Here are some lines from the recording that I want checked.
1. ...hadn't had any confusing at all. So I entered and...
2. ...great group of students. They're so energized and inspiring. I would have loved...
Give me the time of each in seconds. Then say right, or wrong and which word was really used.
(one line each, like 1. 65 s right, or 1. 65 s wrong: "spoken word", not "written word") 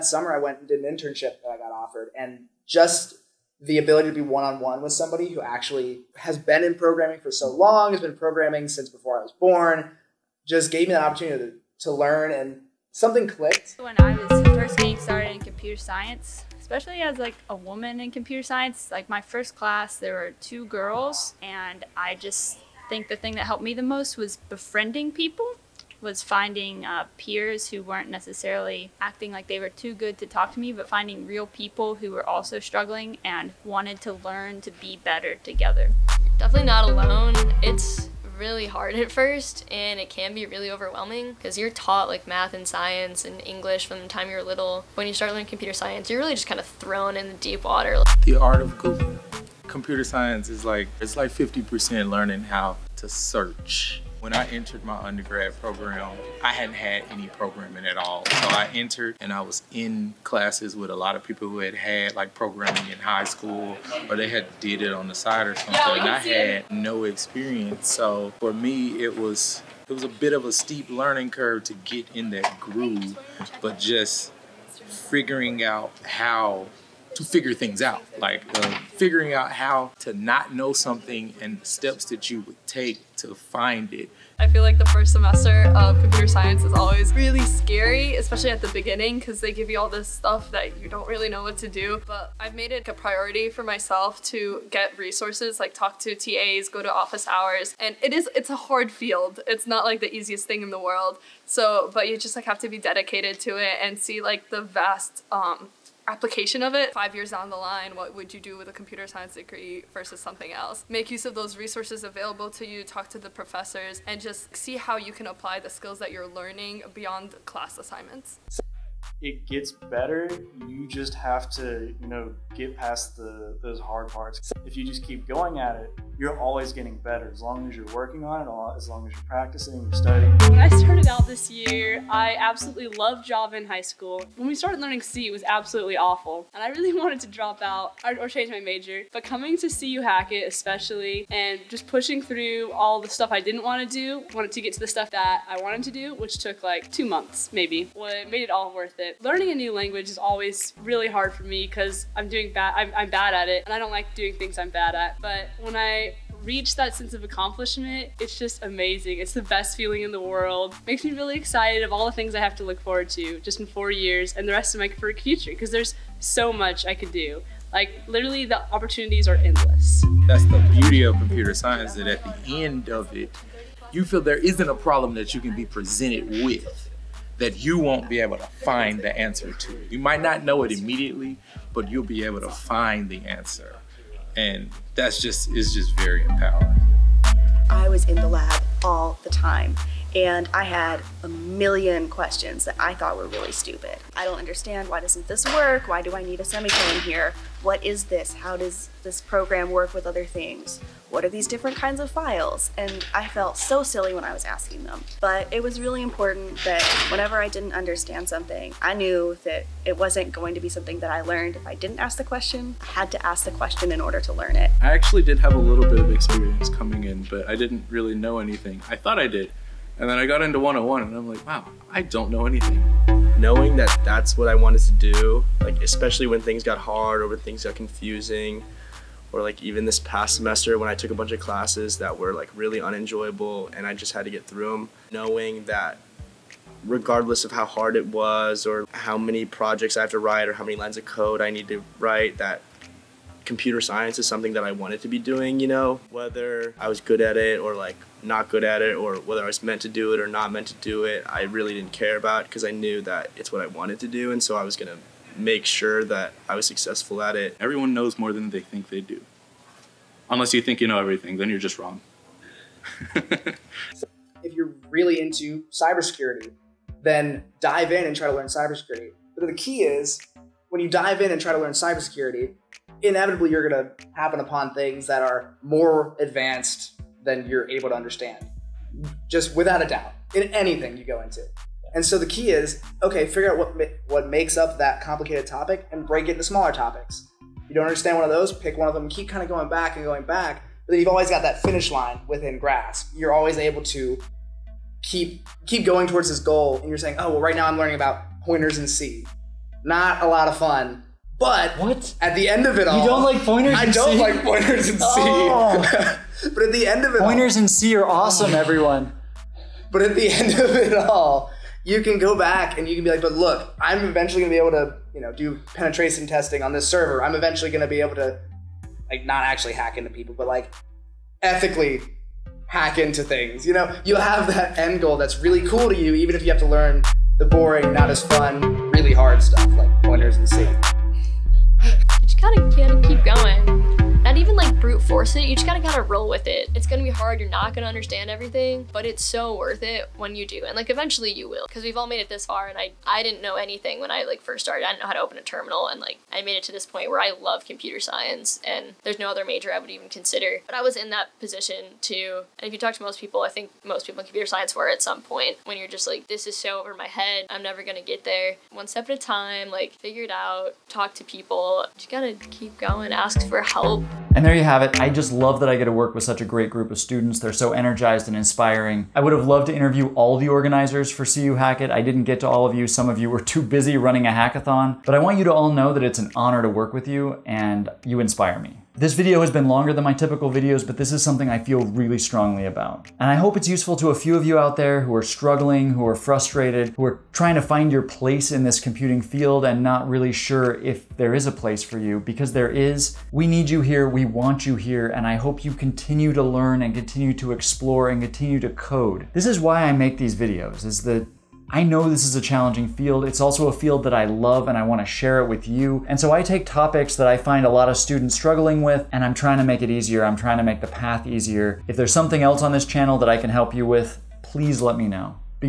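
1. 56 s wrong: "programming", not "confusing"
2. 366 s right.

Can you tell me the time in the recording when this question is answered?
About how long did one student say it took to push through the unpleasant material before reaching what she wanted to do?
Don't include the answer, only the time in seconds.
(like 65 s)
146 s.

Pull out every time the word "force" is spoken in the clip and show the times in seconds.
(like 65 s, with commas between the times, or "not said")
335 s.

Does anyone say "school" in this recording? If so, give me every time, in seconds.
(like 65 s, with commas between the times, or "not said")
63 s, 133 s.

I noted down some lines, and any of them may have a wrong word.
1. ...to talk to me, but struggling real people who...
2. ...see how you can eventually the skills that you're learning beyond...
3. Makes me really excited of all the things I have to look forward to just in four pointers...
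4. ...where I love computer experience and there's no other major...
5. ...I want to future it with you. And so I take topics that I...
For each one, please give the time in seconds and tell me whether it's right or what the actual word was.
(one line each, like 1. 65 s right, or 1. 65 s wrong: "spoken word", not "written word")
1. 30 s wrong: "finding", not "struggling"
2. 114 s wrong: "apply", not "eventually"
3. 160 s wrong: "years", not "pointers"
4. 347 s wrong: "science", not "experience"
5. 404 s wrong: "share", not "future".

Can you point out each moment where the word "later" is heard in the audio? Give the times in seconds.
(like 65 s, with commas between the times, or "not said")
not said.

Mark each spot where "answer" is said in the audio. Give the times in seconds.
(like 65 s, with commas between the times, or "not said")
179 s, 183 s.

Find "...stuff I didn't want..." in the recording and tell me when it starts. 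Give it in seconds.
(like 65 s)
143 s.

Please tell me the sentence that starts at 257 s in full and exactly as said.
Everyone knows more than they think they do.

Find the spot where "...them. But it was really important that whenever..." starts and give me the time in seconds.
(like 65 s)
204 s.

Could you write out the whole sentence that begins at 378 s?
This video has been longer than my typical videos, but this is something I feel really strongly about.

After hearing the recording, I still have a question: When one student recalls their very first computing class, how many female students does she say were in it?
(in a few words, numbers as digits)
2.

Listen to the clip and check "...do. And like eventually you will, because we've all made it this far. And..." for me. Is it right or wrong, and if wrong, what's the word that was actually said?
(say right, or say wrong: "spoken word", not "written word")
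right.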